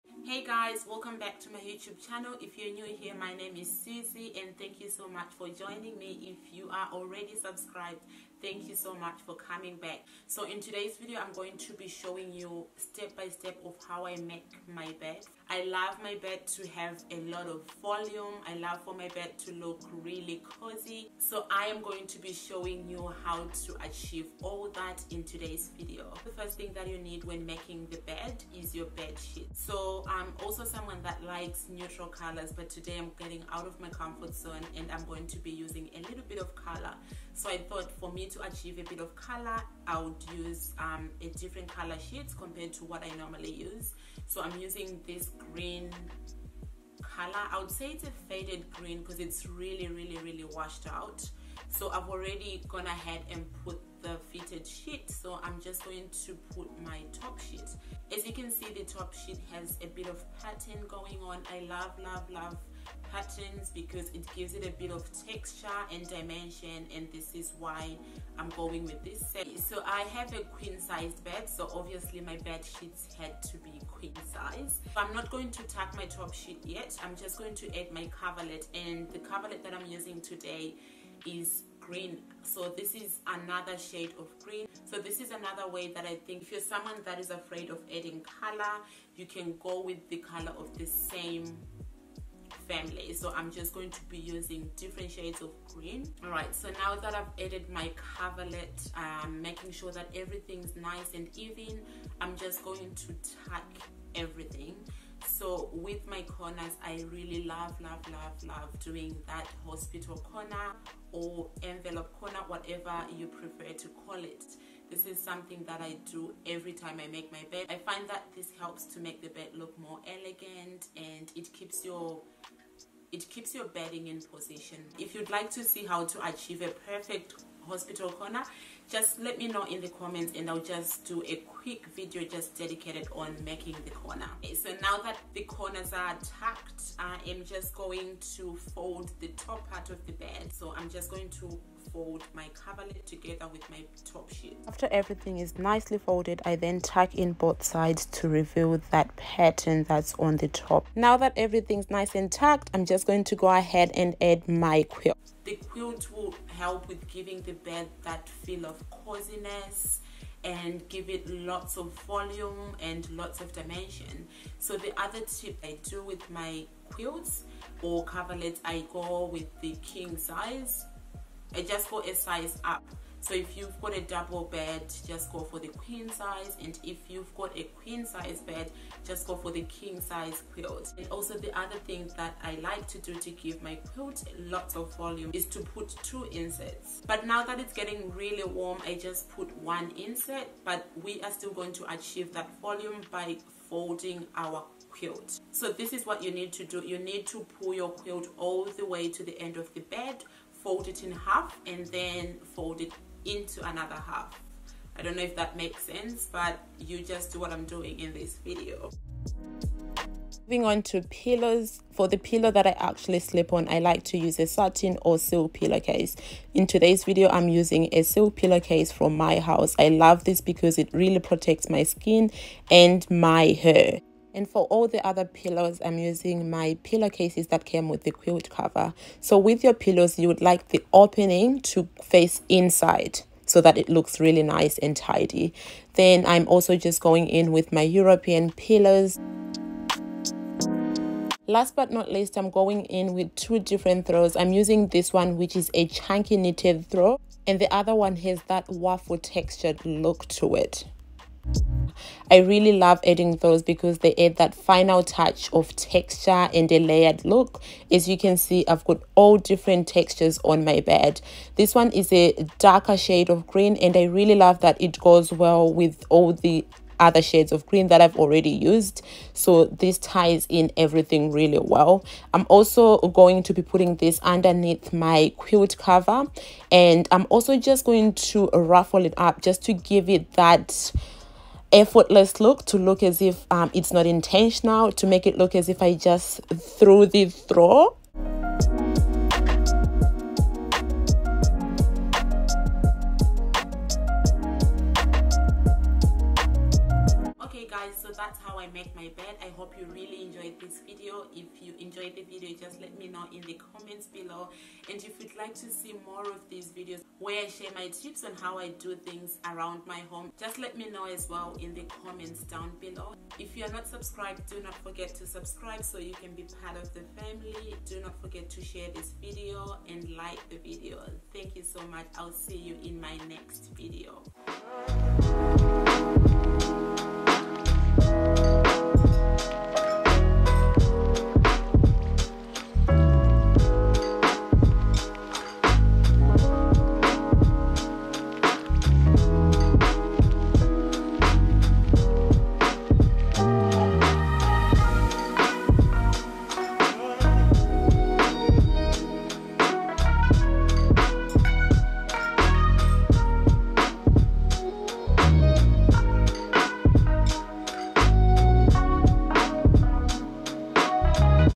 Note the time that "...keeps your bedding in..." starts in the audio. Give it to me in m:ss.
2:03.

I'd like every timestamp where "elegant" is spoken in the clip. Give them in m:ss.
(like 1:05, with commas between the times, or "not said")
2:00.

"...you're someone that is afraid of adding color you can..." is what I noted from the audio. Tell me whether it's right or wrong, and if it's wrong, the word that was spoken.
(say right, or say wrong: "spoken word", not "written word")
right.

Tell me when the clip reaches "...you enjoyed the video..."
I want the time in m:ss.
5:01.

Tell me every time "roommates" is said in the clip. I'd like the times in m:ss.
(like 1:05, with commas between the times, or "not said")
not said.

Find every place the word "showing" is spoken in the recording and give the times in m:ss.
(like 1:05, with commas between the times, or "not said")
0:11, 0:22.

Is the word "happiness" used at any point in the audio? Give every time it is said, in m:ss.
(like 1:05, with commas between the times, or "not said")
not said.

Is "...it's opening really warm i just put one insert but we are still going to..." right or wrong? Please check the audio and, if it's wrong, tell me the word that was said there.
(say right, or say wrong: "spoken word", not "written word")
wrong: "getting", not "opening".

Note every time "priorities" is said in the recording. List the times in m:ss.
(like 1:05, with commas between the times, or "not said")
not said.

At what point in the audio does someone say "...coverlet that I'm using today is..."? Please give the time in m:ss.
1:19.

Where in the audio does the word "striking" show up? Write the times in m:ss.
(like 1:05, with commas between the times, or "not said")
not said.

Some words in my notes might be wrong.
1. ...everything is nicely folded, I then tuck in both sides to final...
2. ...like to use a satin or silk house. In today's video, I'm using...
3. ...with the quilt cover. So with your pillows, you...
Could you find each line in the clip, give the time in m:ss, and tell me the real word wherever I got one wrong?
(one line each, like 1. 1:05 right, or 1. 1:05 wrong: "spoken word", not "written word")
1. 2:24 wrong: "reveal", not "final"
2. 3:33 wrong: "pillowcase", not "house"
3. 3:47 right.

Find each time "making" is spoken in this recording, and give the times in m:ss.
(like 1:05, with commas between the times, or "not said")
0:27, 1:39, 2:13.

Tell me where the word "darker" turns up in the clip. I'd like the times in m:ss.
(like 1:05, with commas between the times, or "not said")
4:22.